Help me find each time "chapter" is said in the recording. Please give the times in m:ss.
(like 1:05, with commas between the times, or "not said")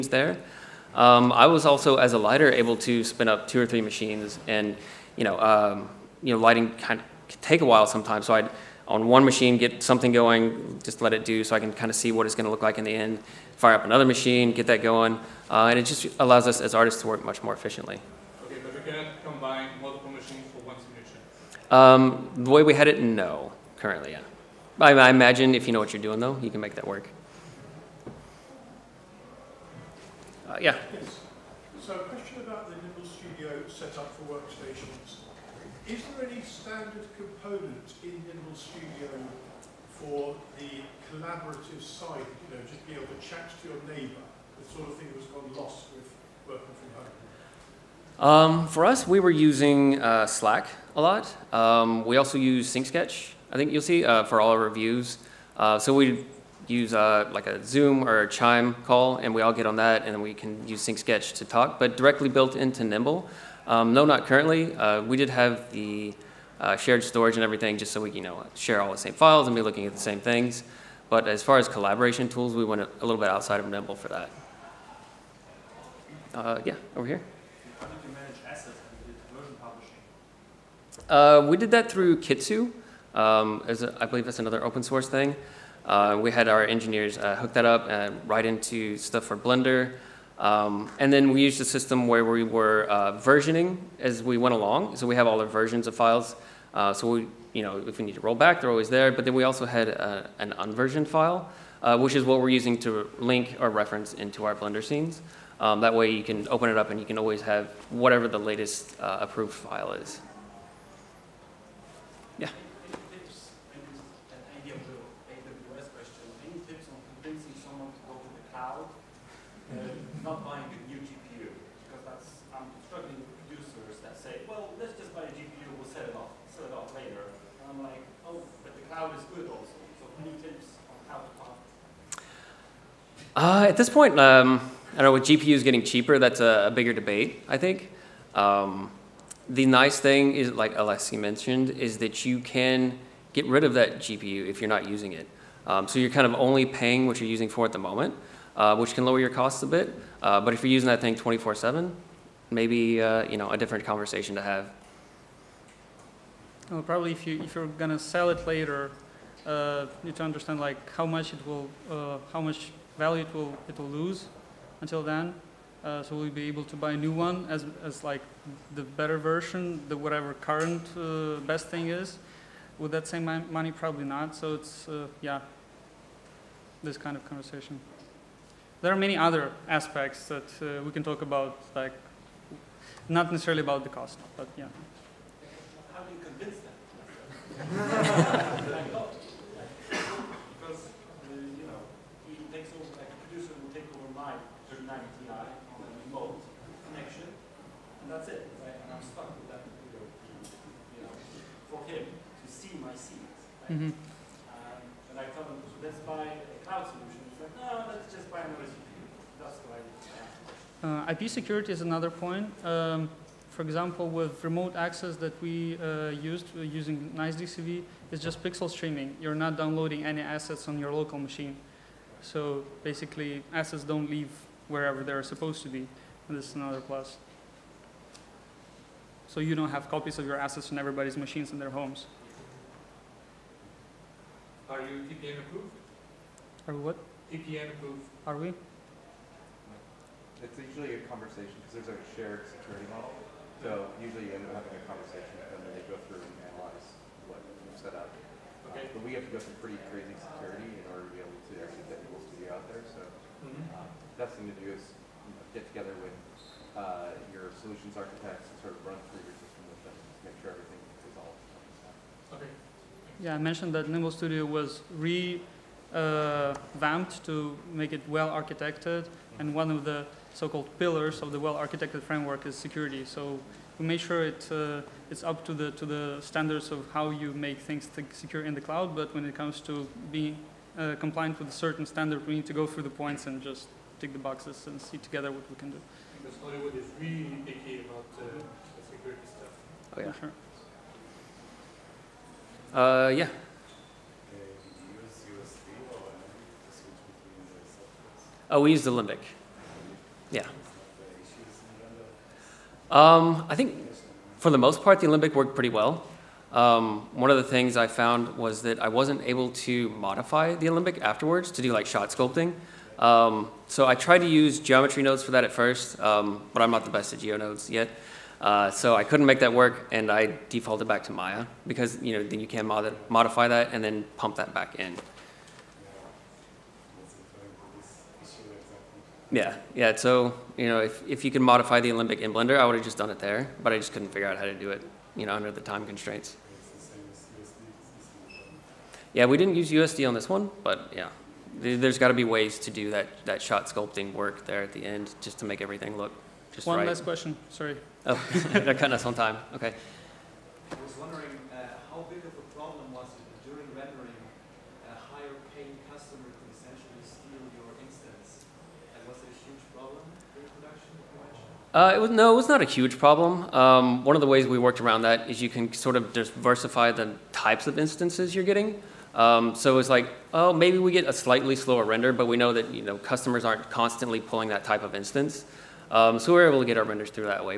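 not said.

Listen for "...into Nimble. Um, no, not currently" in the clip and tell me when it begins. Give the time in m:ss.
1:02.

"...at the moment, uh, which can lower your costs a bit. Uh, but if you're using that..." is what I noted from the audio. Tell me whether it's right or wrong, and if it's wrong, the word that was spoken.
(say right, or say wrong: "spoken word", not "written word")
right.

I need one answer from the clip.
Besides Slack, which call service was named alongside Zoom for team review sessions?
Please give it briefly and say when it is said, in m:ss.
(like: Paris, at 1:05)
Chime, at 0:58.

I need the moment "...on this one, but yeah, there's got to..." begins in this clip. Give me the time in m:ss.
5:40.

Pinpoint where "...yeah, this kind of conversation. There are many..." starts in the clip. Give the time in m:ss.
2:55.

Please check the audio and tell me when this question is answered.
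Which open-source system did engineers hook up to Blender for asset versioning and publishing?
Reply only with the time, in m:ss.
1:22.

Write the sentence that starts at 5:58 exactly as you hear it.
And was it a huge problem during production?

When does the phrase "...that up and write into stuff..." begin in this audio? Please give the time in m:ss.
1:27.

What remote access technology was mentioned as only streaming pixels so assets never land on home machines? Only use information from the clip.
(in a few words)
Nice DCV.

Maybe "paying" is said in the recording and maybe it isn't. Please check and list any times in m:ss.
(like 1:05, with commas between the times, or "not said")
2:26, 5:55.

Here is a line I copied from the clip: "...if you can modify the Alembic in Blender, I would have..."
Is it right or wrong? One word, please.
right.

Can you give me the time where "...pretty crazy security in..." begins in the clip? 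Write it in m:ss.
4:09.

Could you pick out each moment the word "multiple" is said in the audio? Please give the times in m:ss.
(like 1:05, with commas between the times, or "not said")
0:19.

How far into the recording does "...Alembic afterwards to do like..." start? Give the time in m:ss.
5:10.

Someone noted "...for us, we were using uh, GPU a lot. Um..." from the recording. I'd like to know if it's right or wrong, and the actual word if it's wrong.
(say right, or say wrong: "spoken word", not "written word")
wrong: "Slack", not "GPU".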